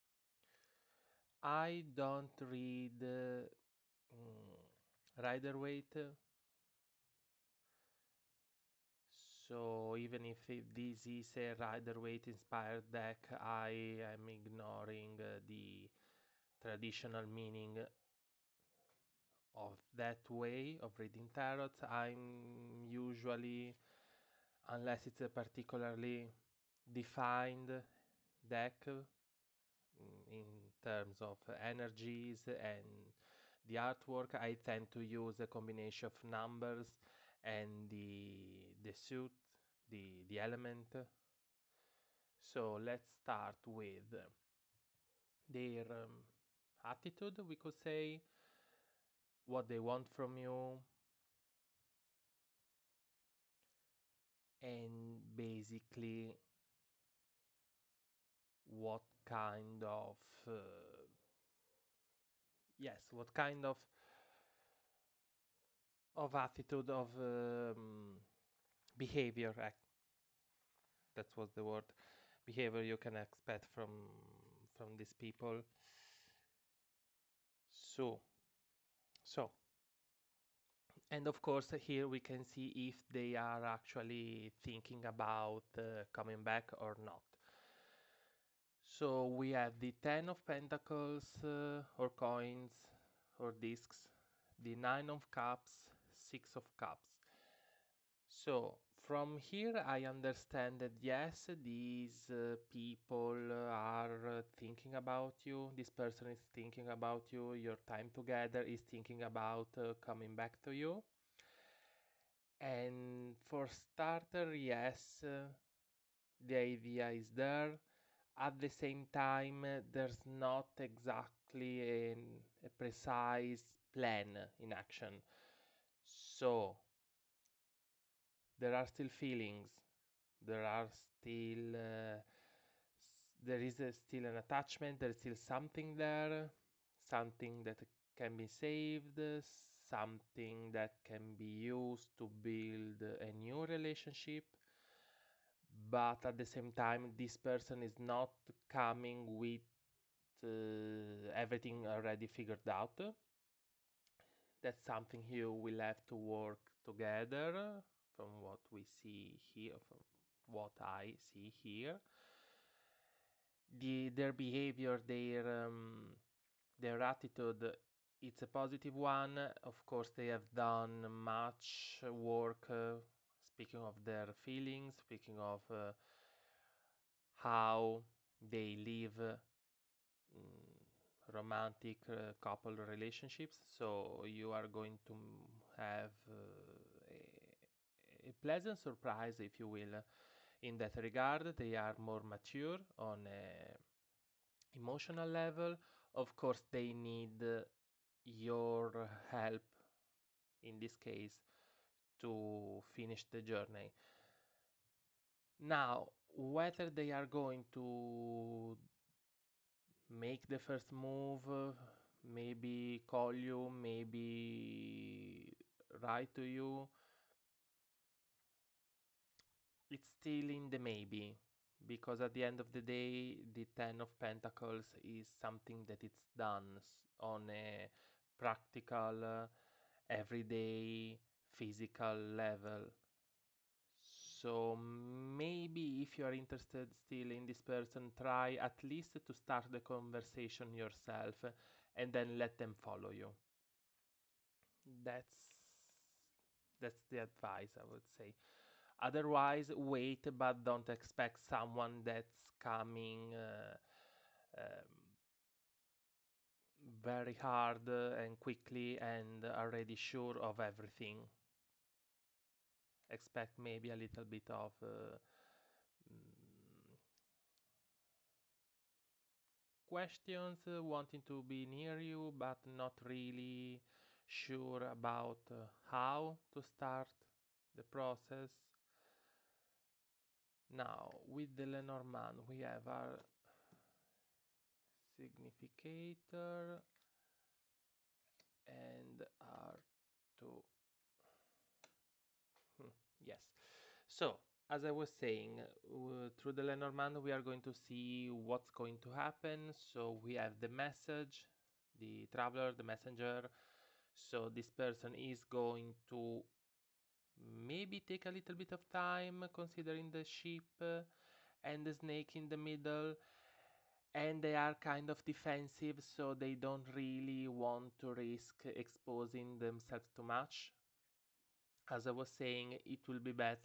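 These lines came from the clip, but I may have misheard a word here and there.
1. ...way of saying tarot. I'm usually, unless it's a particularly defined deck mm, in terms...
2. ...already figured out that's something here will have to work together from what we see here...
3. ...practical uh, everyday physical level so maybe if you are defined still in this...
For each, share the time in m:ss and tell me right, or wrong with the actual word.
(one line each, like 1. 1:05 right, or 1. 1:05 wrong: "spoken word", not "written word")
1. 0:20 wrong: "reading", not "saying"
2. 2:31 right
3. 3:48 wrong: "interested", not "defined".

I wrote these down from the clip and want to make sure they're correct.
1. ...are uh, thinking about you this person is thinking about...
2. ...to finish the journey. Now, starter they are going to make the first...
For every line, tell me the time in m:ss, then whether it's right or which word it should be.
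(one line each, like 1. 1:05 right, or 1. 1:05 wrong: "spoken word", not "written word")
1. 1:43 right
2. 3:22 wrong: "whether", not "starter".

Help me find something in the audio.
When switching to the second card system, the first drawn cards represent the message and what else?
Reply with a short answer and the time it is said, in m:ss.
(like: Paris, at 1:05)
The traveler, at 5:01.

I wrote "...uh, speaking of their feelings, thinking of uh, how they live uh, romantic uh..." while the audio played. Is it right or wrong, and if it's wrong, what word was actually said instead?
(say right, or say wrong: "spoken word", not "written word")
wrong: "speaking", not "thinking".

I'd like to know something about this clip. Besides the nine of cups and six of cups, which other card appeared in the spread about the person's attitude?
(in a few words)
Ten of pentacles.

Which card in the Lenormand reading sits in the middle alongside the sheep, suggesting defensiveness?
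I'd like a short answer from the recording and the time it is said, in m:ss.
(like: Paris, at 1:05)
The snake, at 5:11.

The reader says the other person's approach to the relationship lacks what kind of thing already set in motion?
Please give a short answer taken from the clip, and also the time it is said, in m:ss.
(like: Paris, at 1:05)
A precise plan, at 2:02.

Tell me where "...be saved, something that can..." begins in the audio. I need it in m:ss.
2:18.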